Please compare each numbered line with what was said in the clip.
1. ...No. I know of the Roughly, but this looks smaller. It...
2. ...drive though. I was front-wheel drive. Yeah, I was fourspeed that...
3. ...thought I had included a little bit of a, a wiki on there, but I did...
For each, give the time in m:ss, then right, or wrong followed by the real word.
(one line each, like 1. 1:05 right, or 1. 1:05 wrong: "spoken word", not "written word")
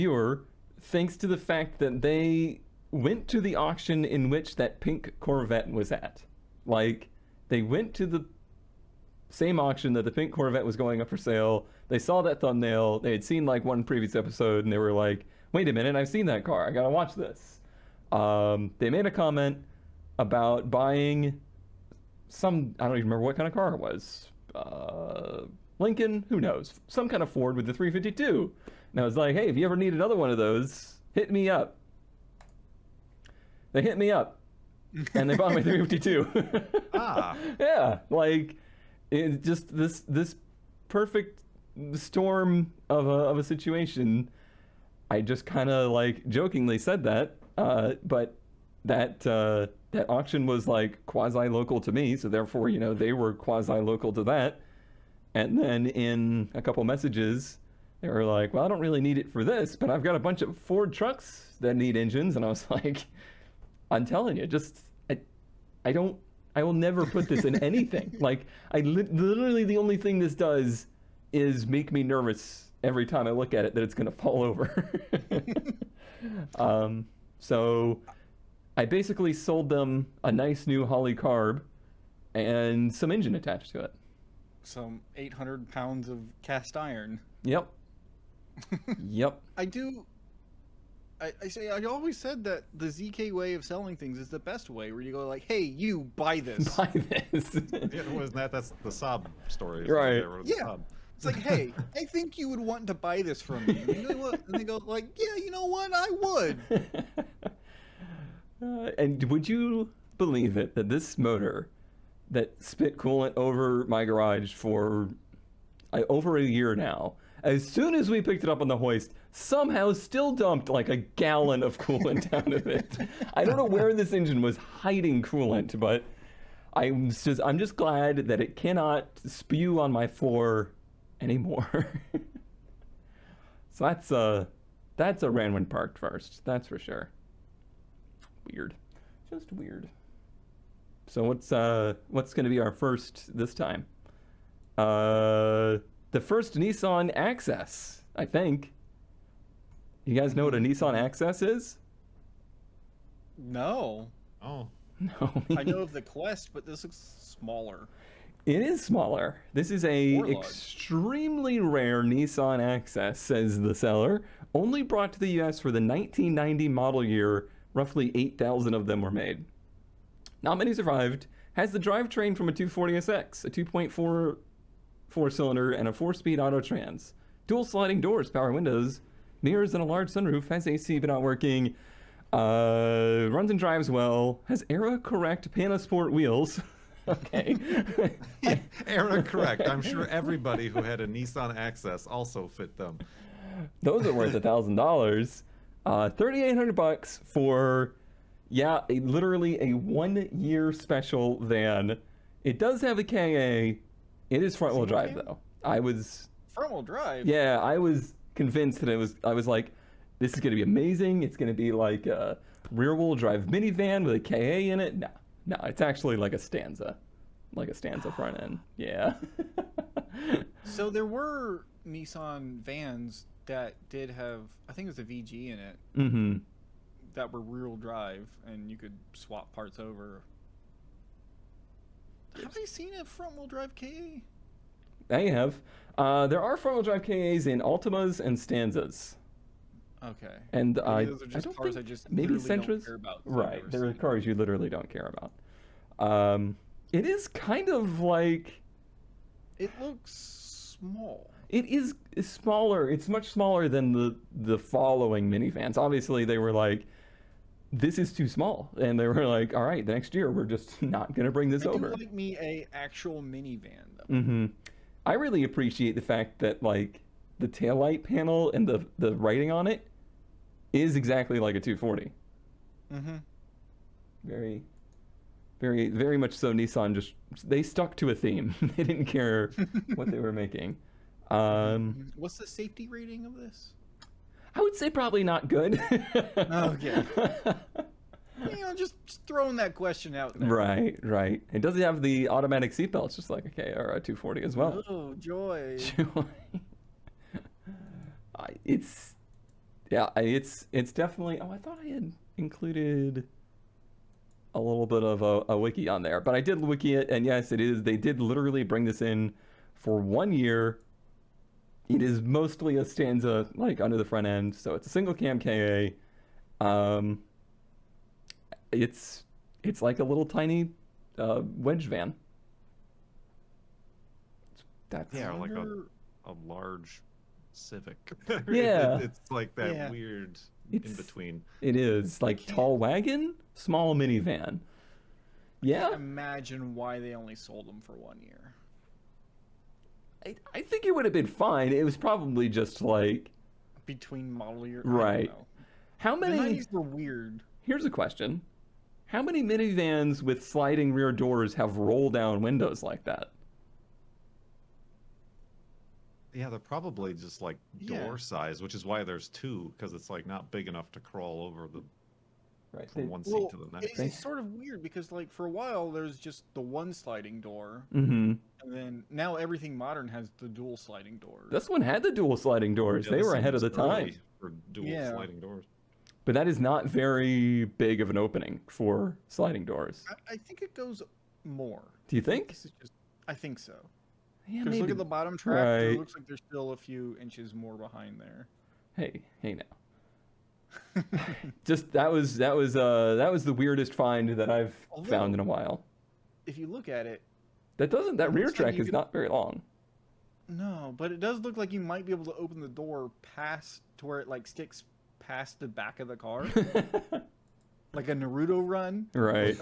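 1. 2:35 wrong: "Quest", not "Roughly"
2. 3:24 wrong: "convinced", not "fourspeed"
3. 5:01 right.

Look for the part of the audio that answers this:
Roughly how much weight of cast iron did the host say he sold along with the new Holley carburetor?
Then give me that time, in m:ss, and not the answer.
1:25.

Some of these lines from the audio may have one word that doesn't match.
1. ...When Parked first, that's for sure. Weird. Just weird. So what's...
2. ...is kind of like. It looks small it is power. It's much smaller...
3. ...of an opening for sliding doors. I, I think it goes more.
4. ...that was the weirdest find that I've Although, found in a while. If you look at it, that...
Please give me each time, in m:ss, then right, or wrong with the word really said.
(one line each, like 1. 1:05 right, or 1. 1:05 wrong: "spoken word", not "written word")
1. 2:15 right
2. 4:07 wrong: "smaller", not "power"
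3. 6:17 right
4. 6:33 right.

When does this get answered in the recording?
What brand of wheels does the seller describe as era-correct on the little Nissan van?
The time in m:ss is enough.
3:05.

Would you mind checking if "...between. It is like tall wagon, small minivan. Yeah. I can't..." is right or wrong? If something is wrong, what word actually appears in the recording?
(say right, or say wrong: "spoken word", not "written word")
right.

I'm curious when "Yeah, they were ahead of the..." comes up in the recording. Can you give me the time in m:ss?
6:13.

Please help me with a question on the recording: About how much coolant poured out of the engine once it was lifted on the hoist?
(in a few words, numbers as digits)
a gallon.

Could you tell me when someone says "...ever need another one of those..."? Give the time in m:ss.
0:29.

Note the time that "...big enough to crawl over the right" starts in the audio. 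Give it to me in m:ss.
6:00.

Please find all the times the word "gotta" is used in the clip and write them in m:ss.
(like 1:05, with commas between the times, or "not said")
0:16.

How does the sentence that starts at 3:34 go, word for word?
No, no, it's actually like a Stanza, like a Stanza front end.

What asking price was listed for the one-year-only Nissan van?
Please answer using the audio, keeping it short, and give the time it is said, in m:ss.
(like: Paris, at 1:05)
$3,800, at 3:16.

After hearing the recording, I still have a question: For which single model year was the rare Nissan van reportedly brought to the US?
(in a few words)
1990.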